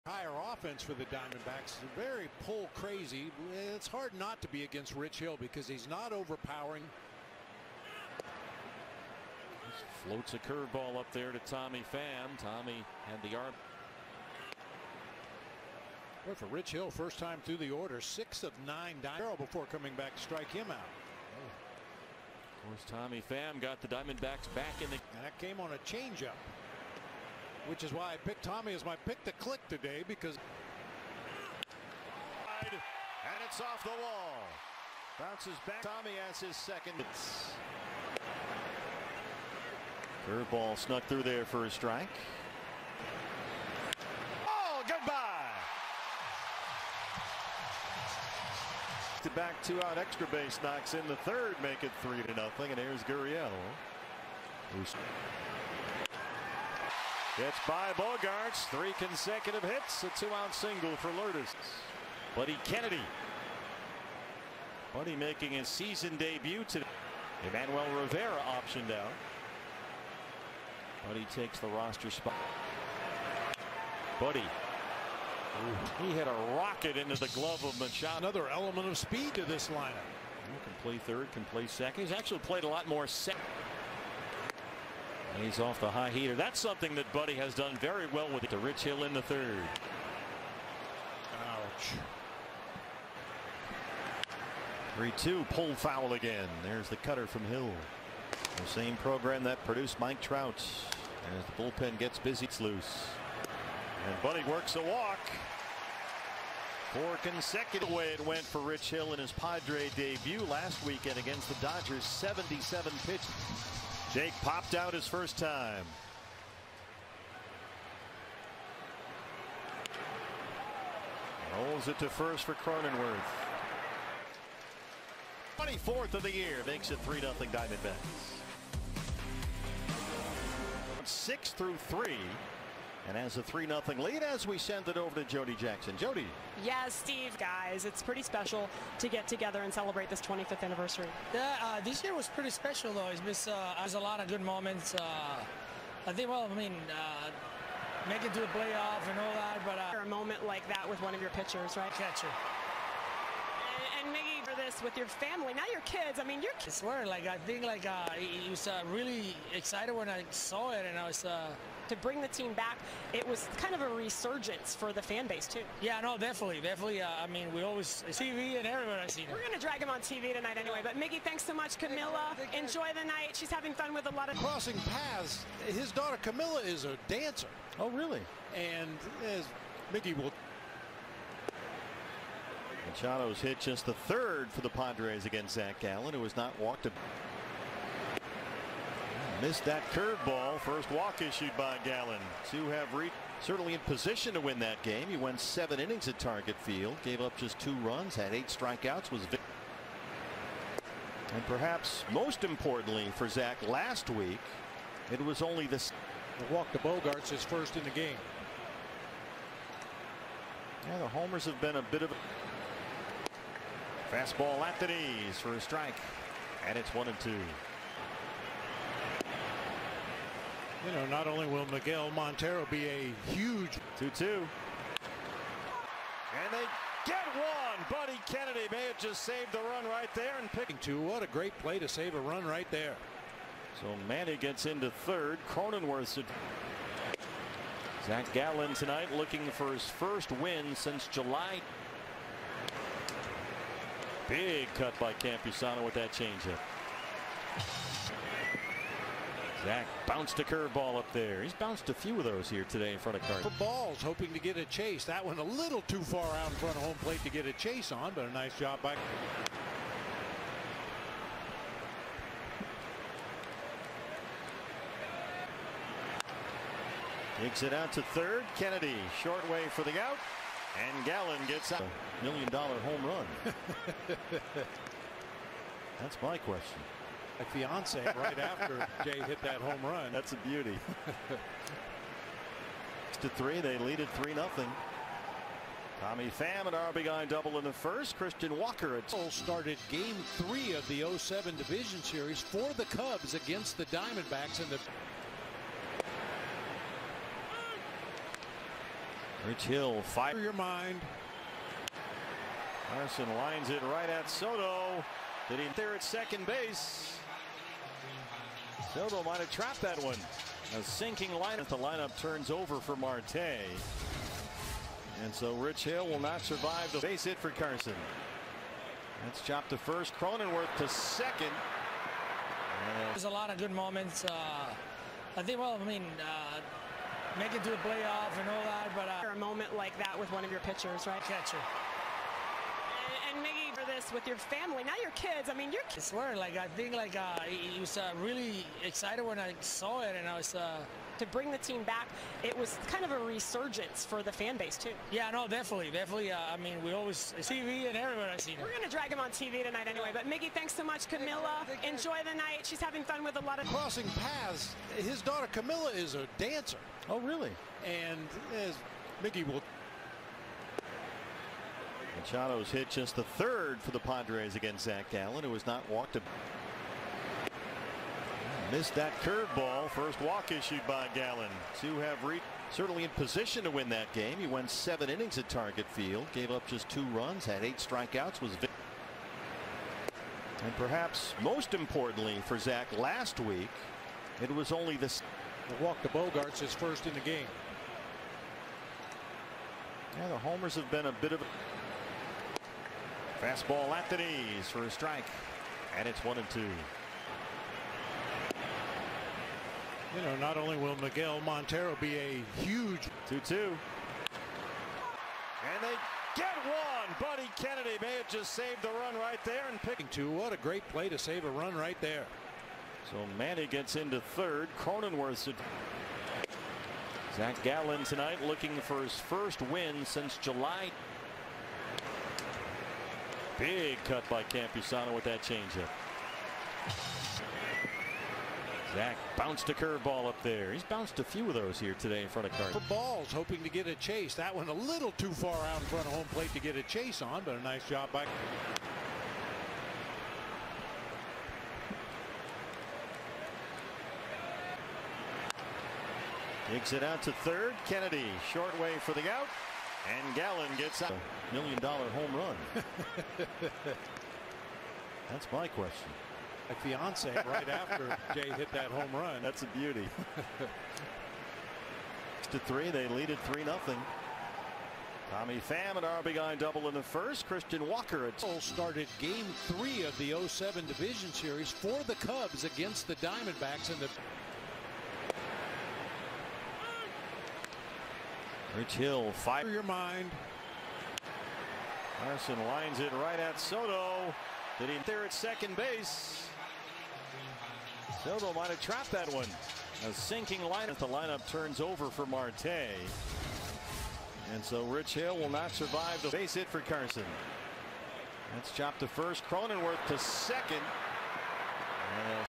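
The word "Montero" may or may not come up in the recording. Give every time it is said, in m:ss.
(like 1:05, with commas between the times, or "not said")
3:42, 6:41.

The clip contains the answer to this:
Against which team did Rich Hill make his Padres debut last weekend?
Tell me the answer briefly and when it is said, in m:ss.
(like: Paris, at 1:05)
Dodgers, at 1:51.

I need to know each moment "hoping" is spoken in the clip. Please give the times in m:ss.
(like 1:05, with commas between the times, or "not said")
4:14, 7:13.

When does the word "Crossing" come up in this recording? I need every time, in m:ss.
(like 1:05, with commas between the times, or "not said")
2:54, 5:53.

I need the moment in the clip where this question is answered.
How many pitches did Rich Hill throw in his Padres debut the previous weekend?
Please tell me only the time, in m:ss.
1:52.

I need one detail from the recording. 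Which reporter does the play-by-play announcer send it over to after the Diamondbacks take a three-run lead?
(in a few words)
Jody Jackson.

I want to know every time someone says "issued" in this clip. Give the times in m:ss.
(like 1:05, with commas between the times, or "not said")
3:11, 6:10.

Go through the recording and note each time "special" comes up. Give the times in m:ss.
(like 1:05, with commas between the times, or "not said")
2:18, 2:22.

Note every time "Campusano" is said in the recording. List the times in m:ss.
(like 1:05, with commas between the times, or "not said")
4:05, 7:04.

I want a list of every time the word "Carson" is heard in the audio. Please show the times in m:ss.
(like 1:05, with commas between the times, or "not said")
5:02, 5:17, 8:16.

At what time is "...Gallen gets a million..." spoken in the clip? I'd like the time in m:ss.
4:31.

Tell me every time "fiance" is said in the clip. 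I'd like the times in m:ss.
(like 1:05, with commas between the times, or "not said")
4:37, 7:36.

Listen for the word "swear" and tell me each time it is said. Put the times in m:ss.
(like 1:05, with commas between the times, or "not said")
2:36, 5:36.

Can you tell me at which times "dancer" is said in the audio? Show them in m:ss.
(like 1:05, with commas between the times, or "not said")
2:57, 5:56.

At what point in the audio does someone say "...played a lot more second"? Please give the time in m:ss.
1:22.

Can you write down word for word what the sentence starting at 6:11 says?
To have reached certainly in position to win that game.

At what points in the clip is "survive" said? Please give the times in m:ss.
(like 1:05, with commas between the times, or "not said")
5:16, 8:15.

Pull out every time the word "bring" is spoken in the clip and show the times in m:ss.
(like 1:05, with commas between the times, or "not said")
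2:41, 5:41.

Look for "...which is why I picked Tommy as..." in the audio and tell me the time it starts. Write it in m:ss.
0:27.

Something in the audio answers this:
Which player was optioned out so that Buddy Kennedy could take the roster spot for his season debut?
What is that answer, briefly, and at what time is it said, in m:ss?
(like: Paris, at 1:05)
Emmanuel Rivera, at 1:07.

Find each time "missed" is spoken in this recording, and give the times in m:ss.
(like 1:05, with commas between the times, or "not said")
3:09, 6:08.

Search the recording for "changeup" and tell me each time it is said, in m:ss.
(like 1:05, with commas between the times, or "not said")
0:25, 4:06, 7:05.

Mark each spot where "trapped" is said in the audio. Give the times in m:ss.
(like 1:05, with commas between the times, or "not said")
5:09, 8:08.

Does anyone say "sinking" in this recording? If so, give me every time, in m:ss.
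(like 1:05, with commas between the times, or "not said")
5:10, 8:10.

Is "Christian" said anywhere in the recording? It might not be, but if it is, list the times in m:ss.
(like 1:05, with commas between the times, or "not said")
4:48, 7:47.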